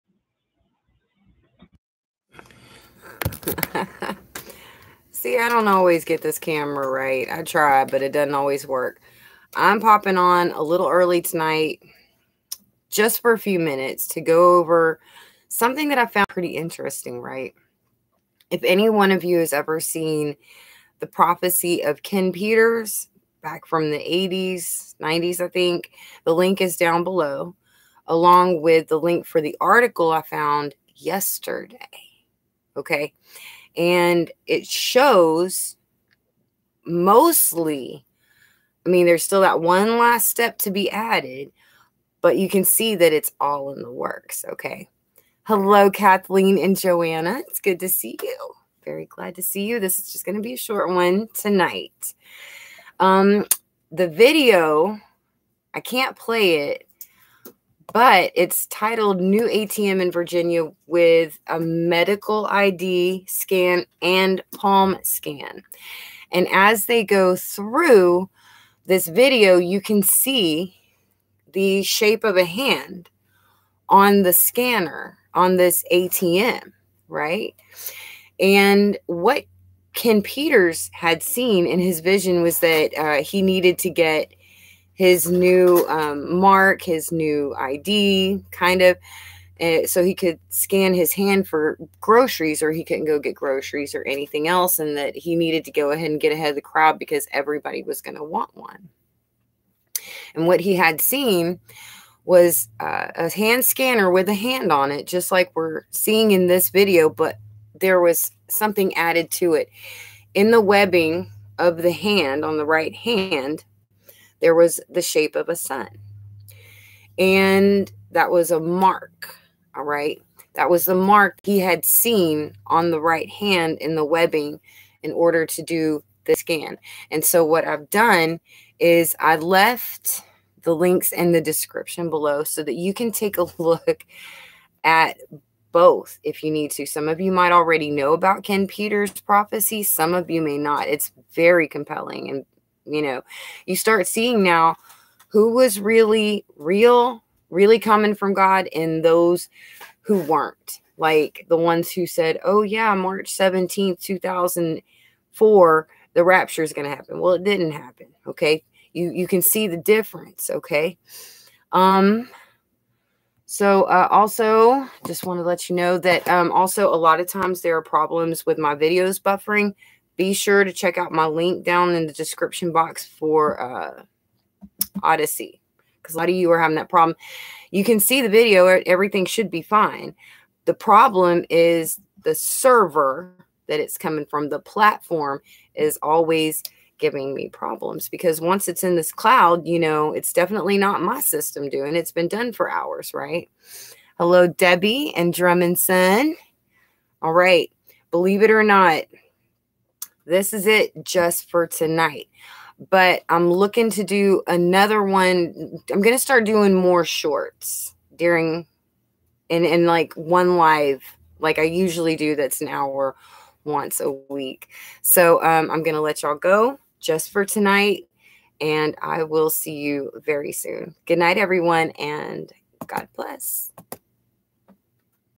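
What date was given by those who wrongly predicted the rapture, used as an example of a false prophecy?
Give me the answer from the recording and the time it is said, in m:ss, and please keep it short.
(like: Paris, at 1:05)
March 17th, 2004, at 2:32.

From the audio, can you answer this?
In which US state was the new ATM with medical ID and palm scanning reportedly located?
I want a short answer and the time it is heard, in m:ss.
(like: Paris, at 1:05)
Virginia, at 1:00.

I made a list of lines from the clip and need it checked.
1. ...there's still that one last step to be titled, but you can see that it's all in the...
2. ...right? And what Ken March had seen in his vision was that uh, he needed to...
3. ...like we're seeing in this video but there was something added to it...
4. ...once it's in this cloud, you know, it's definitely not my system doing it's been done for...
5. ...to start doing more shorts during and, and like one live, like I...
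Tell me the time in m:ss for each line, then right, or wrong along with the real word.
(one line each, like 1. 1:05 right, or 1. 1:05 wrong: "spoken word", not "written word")
1. 0:39 wrong: "added", not "titled"
2. 1:17 wrong: "Peters", not "March"
3. 1:45 right
4. 3:08 right
5. 3:26 right.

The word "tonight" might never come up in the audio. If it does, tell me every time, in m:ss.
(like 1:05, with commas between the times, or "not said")
0:11, 0:51, 3:21, 3:37.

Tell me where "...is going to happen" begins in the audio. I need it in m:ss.
2:36.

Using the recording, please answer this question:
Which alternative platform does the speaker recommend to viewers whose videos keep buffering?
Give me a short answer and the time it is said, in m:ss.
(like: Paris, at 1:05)
Odysee, at 2:55.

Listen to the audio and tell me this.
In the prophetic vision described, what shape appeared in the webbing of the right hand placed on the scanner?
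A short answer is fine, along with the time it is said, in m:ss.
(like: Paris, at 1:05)
sun, at 1:55.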